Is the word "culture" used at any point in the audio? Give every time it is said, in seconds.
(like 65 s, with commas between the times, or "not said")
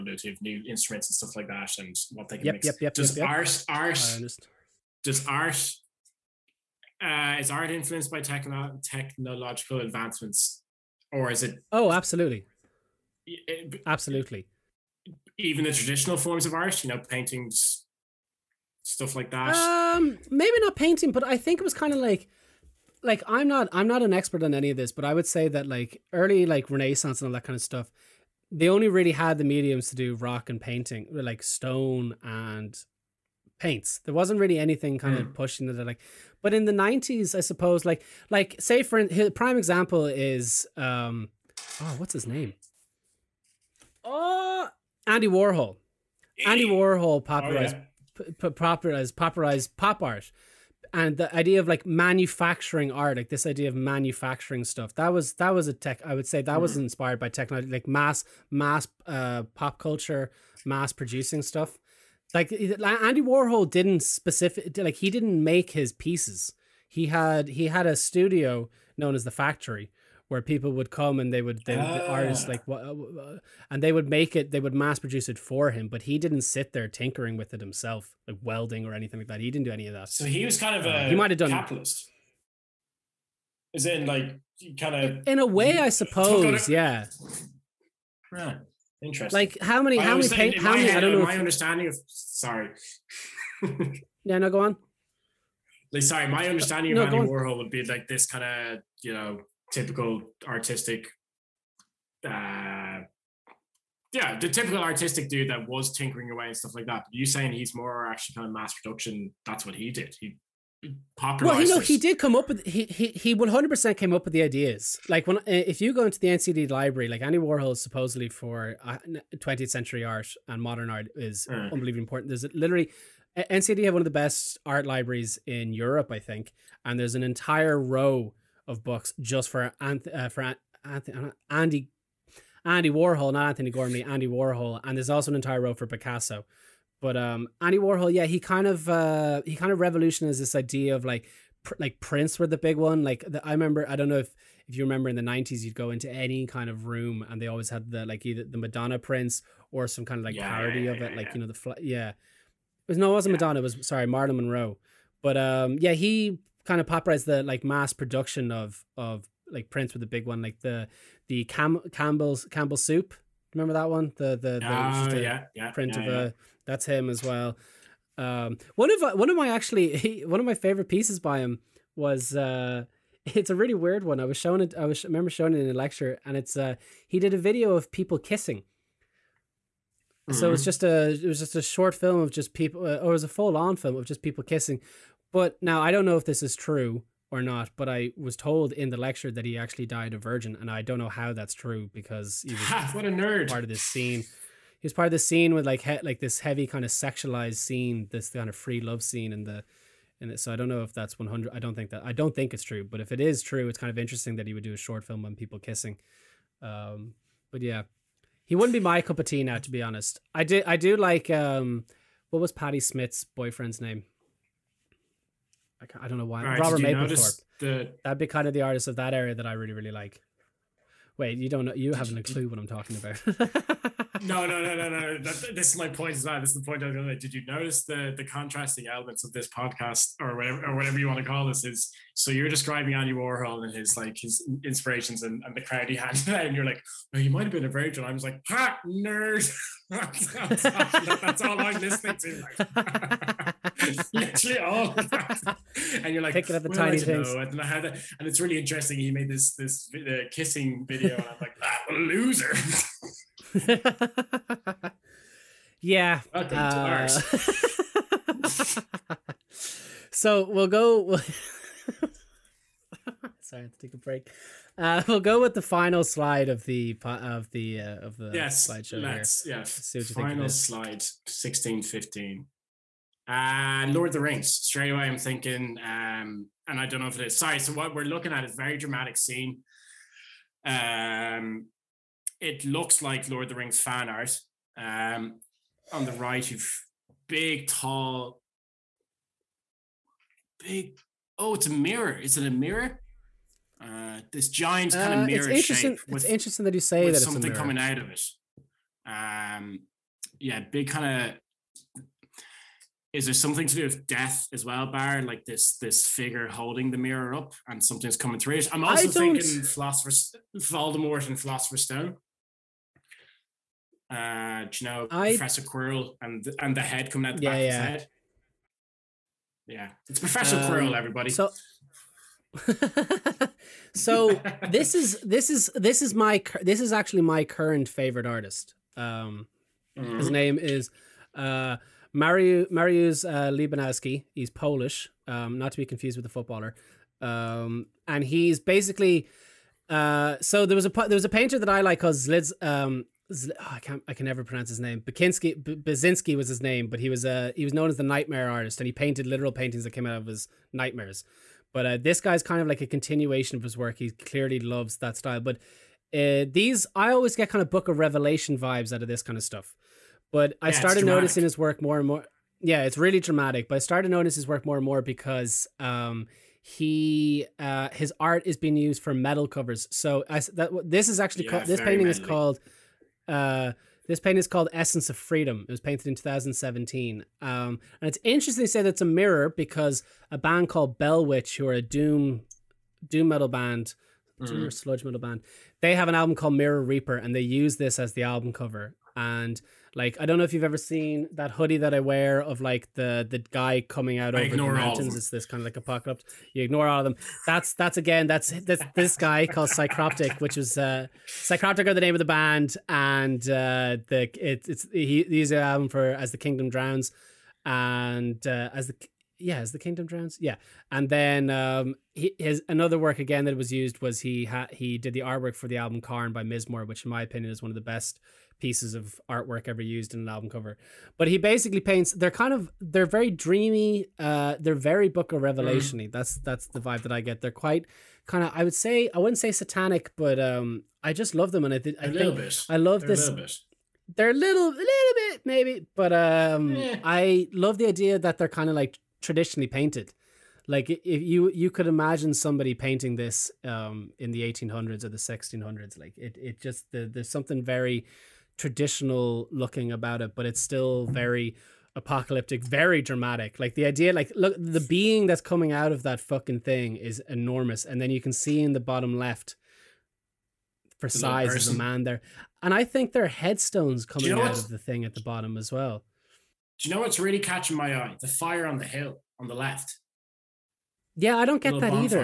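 59 s.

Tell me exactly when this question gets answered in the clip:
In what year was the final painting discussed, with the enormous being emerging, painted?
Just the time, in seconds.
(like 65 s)
376 s.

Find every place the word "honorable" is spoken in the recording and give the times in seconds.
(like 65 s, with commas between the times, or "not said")
not said.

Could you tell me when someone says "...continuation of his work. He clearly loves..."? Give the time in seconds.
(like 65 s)
352 s.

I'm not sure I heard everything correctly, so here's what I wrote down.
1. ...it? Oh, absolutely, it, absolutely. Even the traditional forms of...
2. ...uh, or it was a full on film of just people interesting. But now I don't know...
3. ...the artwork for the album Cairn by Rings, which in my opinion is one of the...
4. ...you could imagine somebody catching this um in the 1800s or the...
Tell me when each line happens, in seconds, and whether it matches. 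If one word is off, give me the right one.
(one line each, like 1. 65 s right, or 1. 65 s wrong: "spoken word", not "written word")
1. 11 s right
2. 182 s wrong: "kissing", not "interesting"
3. 415 s wrong: "Mizmor", not "Rings"
4. 441 s wrong: "painting", not "catching".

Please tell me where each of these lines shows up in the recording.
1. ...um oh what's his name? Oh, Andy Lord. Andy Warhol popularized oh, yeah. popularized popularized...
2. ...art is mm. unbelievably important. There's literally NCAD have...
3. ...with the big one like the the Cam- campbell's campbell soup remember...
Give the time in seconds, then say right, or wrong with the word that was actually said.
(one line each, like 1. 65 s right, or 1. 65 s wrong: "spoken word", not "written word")
1. 40 s wrong: "Warhol", not "Lord"
2. 120 s right
3. 159 s right.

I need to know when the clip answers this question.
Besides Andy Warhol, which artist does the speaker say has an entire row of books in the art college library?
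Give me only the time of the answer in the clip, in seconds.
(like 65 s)
135 s.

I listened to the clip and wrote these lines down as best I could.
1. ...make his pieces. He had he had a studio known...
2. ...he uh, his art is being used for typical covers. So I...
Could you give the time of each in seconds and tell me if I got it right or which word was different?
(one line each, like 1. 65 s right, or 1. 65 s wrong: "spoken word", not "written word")
1. 65 s right
2. 366 s wrong: "metal", not "typical".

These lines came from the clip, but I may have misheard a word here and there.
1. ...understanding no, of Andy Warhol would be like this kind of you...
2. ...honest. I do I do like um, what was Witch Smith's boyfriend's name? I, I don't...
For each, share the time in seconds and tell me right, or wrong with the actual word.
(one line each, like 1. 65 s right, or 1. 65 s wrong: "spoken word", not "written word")
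1. 96 s right
2. 209 s wrong: "Patti", not "Witch".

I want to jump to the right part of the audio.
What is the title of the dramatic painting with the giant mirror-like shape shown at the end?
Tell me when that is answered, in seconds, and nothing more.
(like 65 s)
374 s.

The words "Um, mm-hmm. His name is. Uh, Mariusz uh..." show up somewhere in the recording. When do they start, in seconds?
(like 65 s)
328 s.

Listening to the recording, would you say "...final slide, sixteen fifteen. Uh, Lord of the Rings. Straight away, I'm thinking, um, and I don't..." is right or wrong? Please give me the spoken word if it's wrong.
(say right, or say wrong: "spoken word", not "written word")
right.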